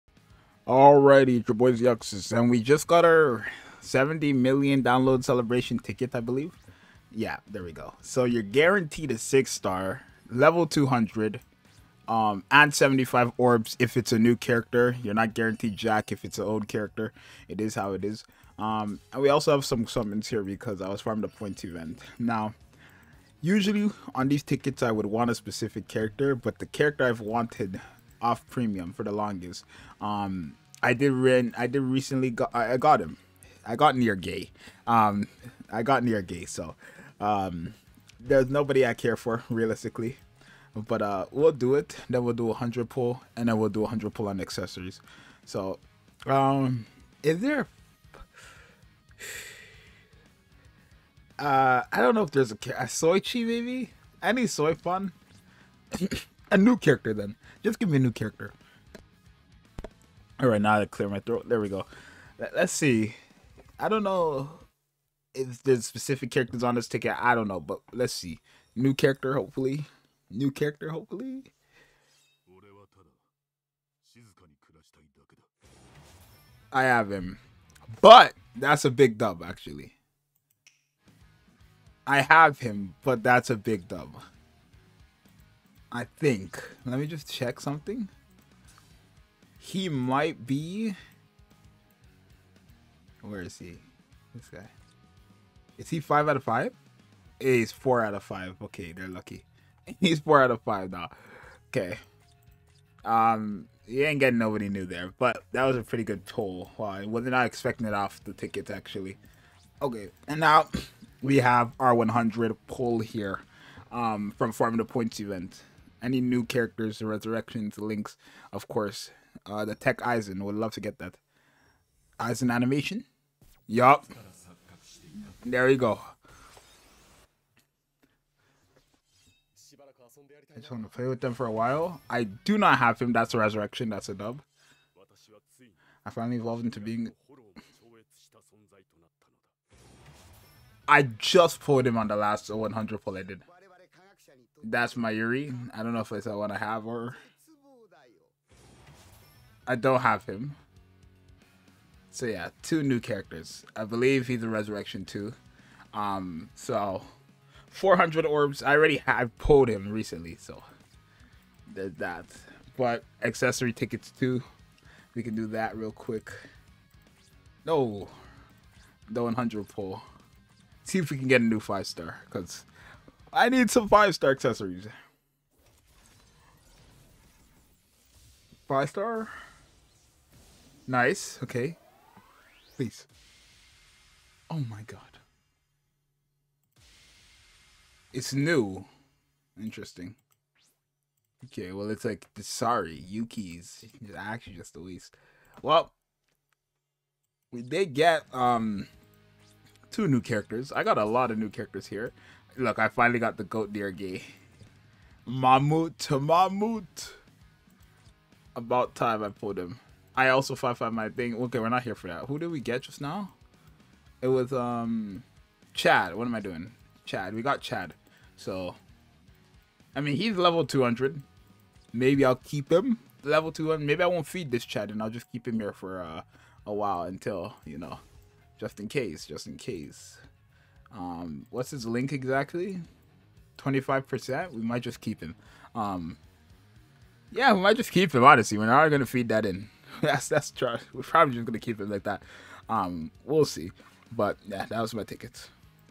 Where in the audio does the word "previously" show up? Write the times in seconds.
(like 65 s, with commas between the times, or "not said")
not said.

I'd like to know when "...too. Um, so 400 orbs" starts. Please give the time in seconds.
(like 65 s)
155 s.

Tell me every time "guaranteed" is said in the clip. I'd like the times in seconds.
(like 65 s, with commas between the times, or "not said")
8 s, 15 s.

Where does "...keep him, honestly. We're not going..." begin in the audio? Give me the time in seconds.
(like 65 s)
237 s.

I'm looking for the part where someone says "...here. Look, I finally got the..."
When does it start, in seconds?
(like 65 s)
201 s.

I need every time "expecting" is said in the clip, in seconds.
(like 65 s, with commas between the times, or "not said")
107 s.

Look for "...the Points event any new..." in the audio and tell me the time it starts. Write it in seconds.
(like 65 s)
114 s.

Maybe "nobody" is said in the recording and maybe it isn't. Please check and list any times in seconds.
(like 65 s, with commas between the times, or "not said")
38 s, 104 s.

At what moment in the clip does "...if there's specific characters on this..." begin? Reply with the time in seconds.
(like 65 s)
65 s.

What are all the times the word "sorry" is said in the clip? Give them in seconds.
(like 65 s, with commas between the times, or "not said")
192 s.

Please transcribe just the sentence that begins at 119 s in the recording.
Uh, the Tech Aizen would love to get that.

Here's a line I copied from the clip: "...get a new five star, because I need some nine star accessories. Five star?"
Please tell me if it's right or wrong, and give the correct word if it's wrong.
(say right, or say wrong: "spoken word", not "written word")
wrong: "five", not "nine".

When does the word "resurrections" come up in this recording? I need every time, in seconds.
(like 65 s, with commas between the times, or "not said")
117 s, 133 s, 154 s.